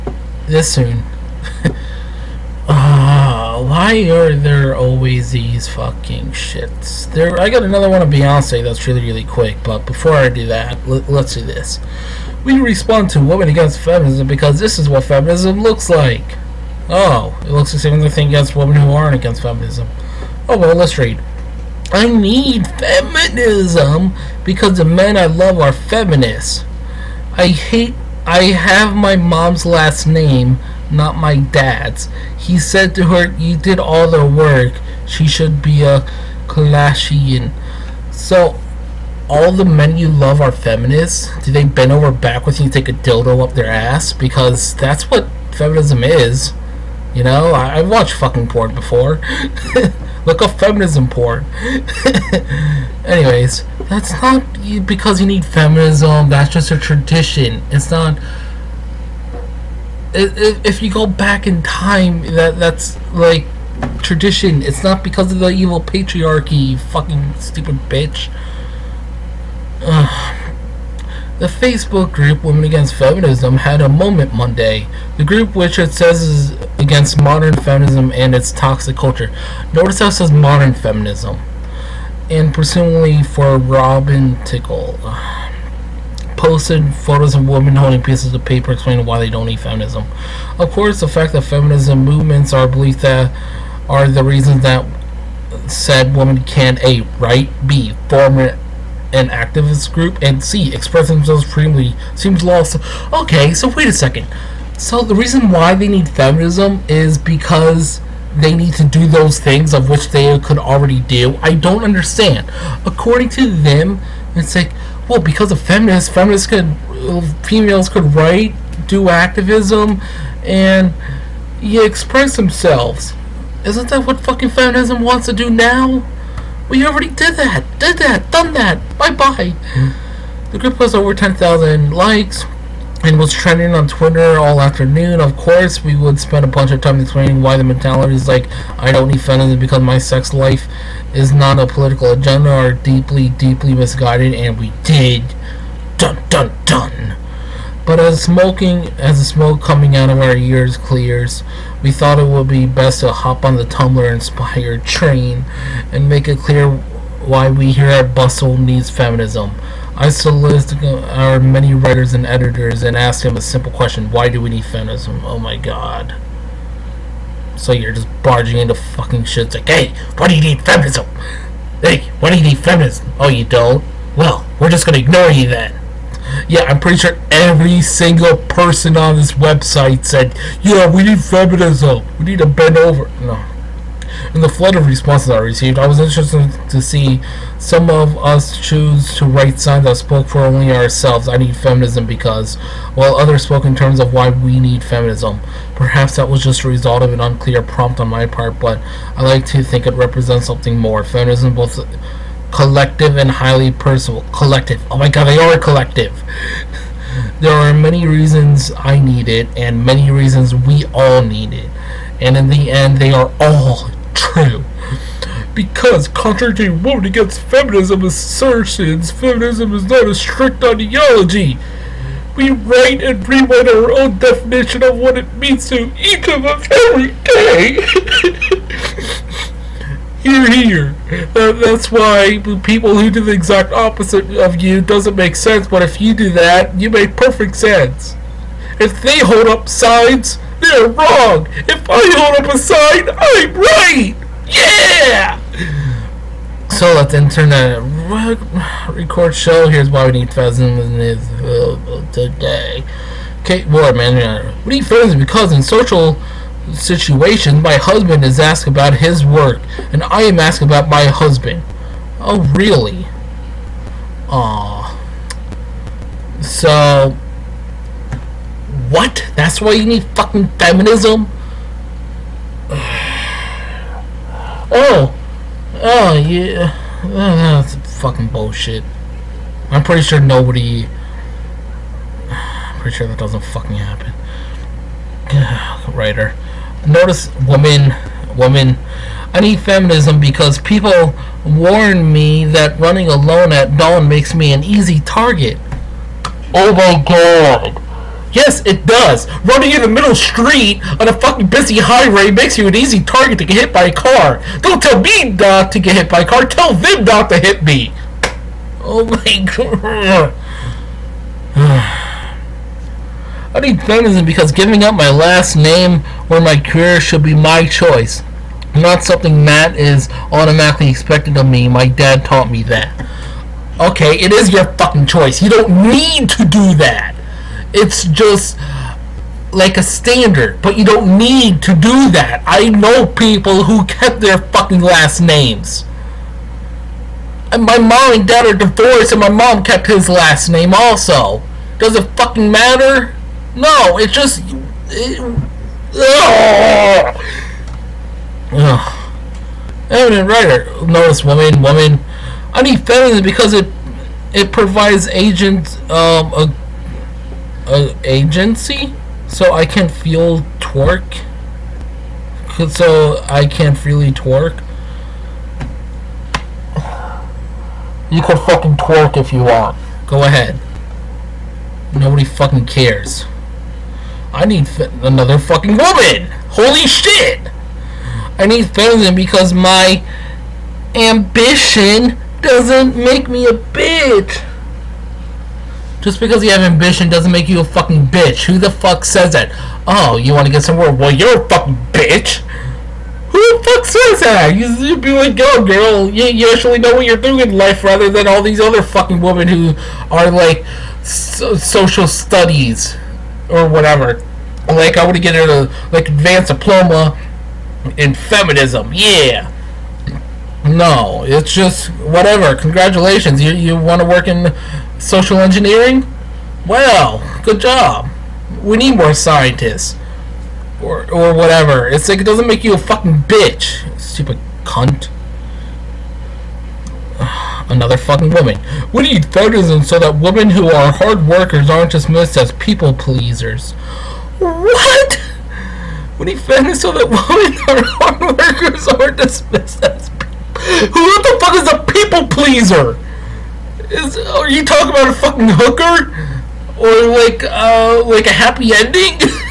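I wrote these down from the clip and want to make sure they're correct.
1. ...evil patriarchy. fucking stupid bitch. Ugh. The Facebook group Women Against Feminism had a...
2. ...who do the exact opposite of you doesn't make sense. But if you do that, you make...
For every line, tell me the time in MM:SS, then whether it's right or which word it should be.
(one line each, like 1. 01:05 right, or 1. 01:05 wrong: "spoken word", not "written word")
1. 01:05 right
2. 03:52 right.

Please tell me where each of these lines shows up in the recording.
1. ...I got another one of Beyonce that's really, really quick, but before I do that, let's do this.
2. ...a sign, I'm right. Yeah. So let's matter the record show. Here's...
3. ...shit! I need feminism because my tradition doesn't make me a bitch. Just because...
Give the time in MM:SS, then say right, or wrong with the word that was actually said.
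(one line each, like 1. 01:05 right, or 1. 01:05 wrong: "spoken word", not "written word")
1. 00:07 right
2. 04:02 wrong: "enter", not "matter"
3. 06:16 wrong: "ambition", not "tradition".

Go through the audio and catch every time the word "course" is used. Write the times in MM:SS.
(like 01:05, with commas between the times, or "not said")
01:30, 02:15.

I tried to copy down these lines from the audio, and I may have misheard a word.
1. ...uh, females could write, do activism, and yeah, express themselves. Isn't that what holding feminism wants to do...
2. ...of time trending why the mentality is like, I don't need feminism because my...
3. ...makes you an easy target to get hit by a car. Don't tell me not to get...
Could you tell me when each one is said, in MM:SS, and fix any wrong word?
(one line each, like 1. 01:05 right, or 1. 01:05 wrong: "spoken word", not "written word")
1. 01:56 wrong: "fucking", not "holding"
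2. 02:16 wrong: "explaining", not "trending"
3. 05:02 right.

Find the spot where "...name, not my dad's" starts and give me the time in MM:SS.
00:30.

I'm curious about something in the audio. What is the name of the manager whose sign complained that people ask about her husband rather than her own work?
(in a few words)
Kate Ward.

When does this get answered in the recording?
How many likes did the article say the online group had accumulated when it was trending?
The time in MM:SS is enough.
02:10.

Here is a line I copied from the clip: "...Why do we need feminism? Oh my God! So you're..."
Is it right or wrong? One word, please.
right.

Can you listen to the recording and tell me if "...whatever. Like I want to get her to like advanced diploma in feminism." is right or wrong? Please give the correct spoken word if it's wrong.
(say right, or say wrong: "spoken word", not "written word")
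right.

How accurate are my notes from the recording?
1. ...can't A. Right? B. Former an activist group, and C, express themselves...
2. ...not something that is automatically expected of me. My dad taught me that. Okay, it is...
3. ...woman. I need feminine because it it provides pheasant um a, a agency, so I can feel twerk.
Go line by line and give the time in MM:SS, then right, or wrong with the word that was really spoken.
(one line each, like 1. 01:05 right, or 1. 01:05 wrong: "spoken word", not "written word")
1. 01:36 right
2. 05:18 right
3. 05:51 wrong: "agent", not "pheasant".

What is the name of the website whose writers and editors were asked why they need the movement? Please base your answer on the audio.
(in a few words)
Bustle.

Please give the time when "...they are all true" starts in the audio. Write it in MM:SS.
03:32.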